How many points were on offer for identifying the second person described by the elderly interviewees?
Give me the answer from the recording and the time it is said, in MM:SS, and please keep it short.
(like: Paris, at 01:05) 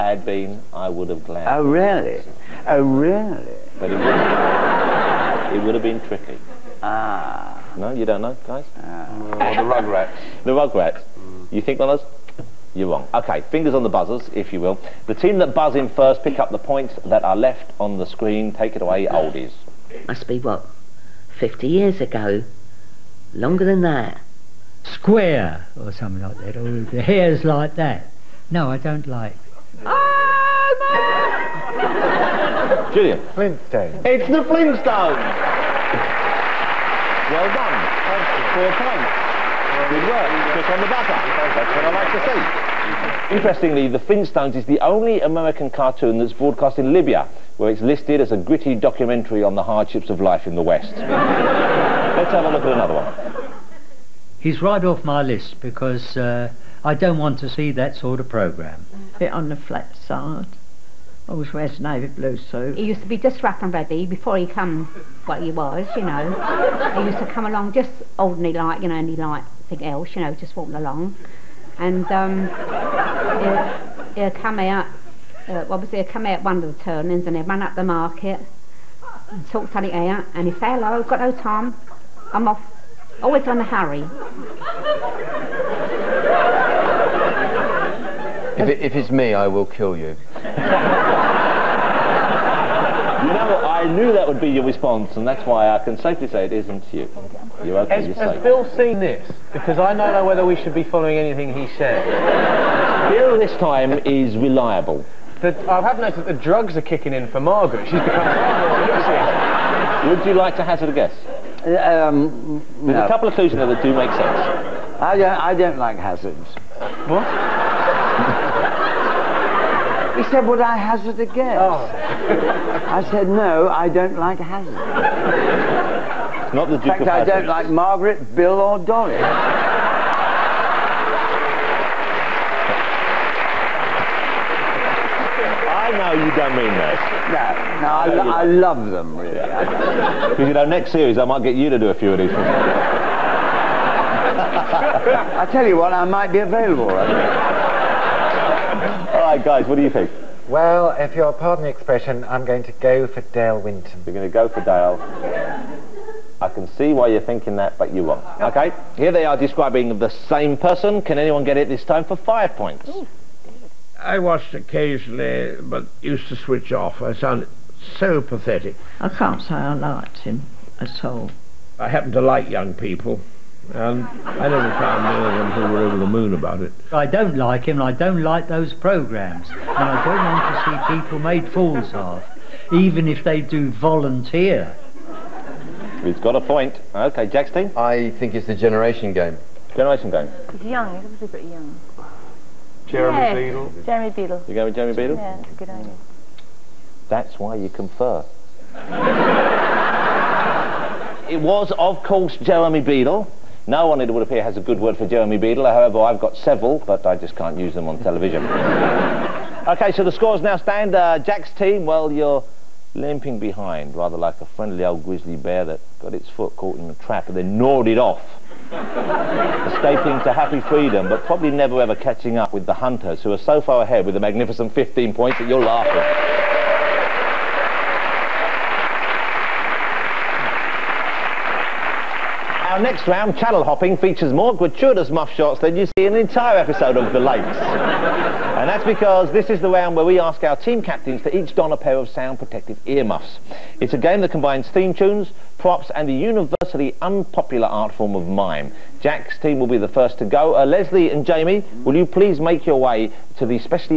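5, at 02:42.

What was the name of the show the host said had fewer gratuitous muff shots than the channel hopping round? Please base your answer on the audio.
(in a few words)
The Lakes.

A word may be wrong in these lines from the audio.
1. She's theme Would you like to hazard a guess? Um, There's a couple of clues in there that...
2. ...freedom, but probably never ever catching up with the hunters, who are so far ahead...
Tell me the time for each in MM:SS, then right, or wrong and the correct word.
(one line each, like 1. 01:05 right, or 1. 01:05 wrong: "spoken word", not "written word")
1. 01:47 wrong: "become", not "theme"
2. 03:40 right.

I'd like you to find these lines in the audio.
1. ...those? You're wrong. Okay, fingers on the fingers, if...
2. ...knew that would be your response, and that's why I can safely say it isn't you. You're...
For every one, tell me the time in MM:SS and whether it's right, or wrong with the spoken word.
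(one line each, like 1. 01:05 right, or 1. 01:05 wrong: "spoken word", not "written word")
1. 00:12 wrong: "buzzers", not "fingers"
2. 01:33 right.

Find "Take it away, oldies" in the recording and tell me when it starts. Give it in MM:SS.
00:18.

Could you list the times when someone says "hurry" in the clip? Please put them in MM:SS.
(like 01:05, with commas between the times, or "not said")
01:23.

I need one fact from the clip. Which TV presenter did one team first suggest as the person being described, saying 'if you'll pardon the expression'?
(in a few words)
Dale Winton.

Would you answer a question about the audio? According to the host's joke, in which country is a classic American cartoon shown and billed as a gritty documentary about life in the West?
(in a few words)
Libya.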